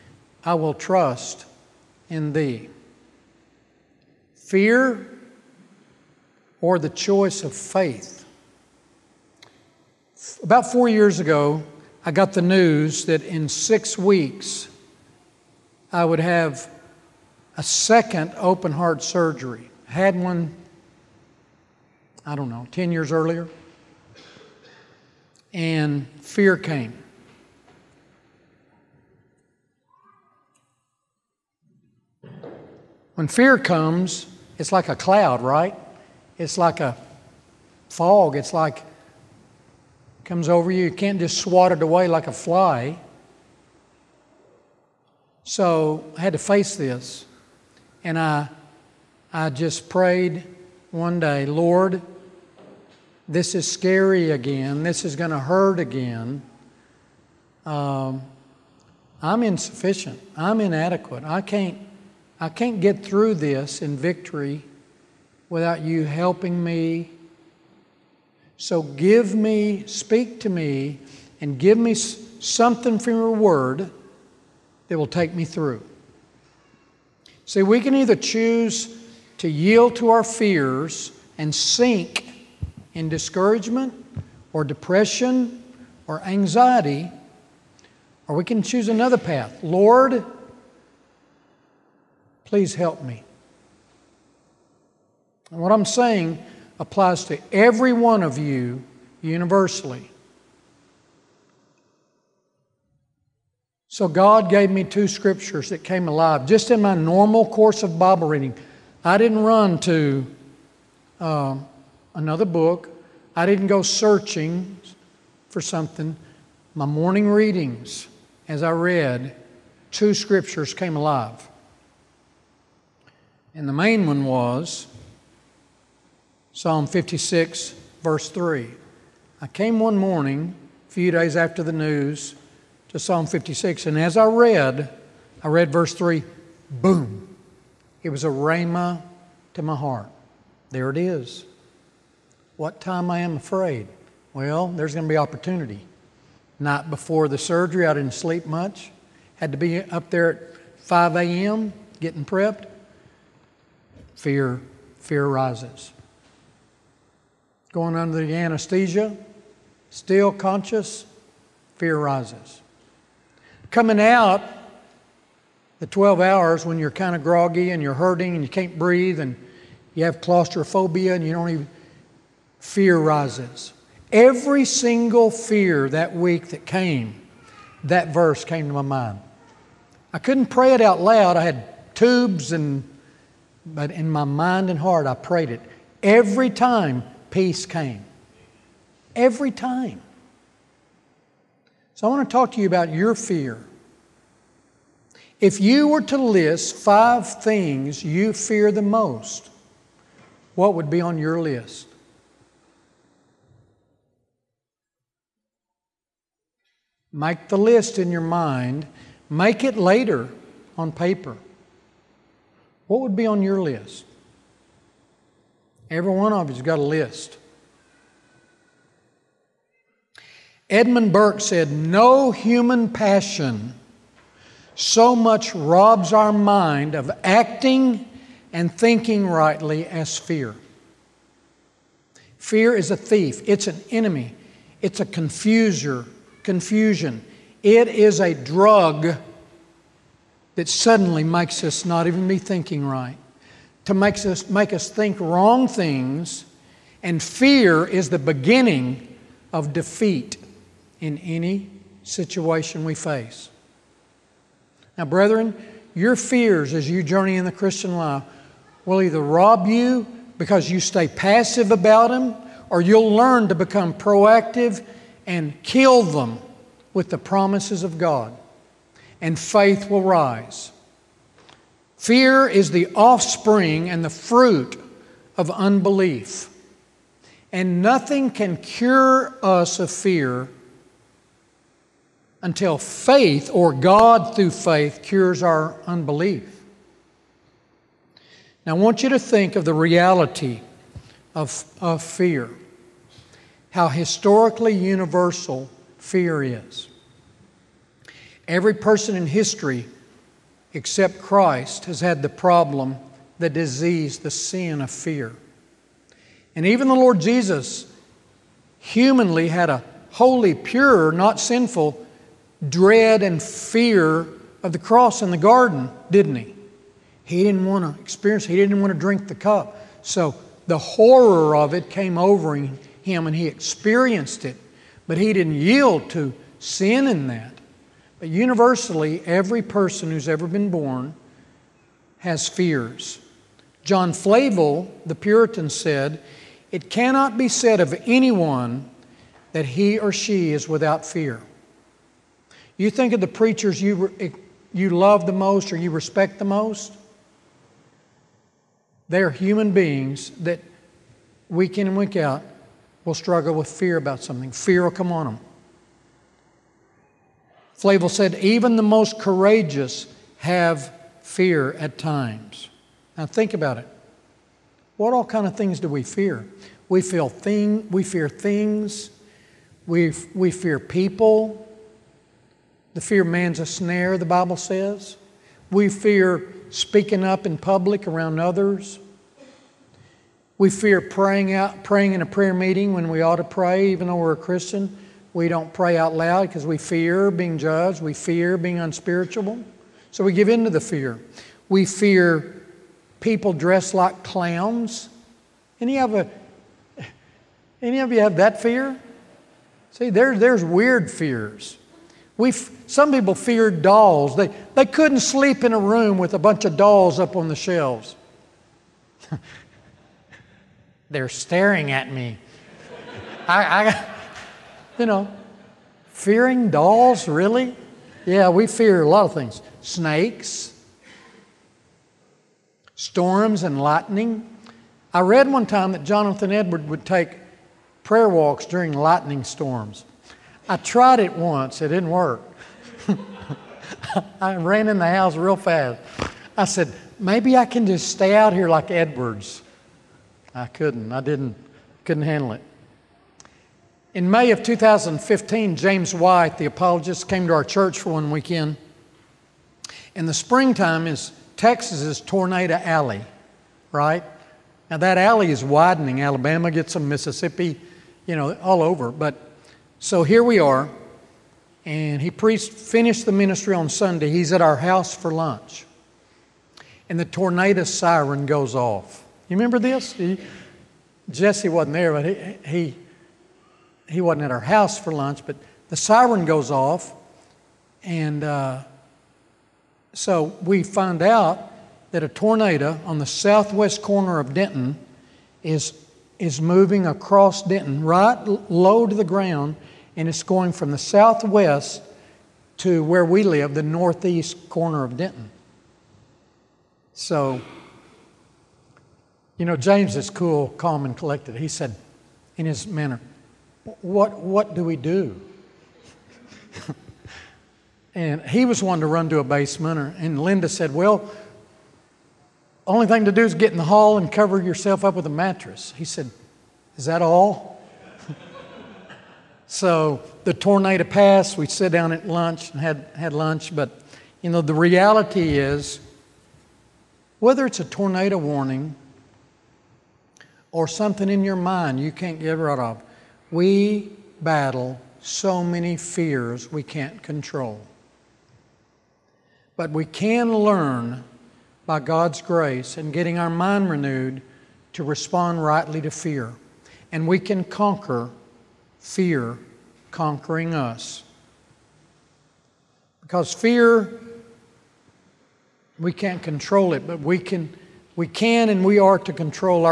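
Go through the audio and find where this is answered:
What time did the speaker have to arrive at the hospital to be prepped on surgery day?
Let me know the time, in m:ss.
2:30.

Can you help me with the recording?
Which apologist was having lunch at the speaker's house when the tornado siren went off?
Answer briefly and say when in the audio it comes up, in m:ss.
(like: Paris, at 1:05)
James White, at 7:25.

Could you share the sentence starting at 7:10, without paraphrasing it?
I tried it once, it didn't work.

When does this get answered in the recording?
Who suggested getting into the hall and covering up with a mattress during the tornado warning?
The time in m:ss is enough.
8:30.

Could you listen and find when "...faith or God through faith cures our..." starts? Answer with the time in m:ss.
4:42.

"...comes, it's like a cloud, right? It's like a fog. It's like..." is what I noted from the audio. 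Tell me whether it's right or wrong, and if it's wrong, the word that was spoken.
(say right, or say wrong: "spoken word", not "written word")
right.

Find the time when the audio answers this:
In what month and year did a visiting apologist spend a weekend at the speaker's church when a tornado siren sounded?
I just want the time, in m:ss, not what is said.
7:24.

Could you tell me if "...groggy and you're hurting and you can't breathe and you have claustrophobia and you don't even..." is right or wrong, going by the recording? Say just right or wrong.
right.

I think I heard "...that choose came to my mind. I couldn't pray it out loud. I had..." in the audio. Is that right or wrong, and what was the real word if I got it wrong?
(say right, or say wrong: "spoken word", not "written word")
wrong: "verse", not "choose".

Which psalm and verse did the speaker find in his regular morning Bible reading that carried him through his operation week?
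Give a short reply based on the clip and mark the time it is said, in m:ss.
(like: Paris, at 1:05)
Psalm 56, verse 3, at 2:06.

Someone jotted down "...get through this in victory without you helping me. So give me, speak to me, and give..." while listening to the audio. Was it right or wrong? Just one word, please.
right.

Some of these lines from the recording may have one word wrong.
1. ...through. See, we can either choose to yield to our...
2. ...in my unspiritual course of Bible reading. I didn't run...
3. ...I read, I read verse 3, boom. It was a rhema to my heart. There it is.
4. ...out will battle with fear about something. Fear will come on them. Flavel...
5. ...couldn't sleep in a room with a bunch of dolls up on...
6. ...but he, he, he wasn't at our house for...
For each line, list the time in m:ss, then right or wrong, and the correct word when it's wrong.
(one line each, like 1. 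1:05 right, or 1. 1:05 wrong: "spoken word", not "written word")
1. 1:15 right
2. 1:46 wrong: "normal", not "unspiritual"
3. 2:14 right
4. 5:52 wrong: "struggle", not "battle"
5. 6:44 right
6. 7:52 right.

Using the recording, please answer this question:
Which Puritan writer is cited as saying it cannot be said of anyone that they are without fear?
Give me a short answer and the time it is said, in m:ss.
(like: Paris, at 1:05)
John Flavel, at 5:33.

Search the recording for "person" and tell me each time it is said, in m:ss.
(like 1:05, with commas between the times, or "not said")
4:58, 5:29.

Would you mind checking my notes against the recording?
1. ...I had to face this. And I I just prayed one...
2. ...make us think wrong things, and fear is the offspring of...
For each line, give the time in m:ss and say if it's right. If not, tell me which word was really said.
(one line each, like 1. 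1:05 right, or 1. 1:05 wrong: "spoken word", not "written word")
1. 0:46 right
2. 4:04 wrong: "beginning", not "offspring".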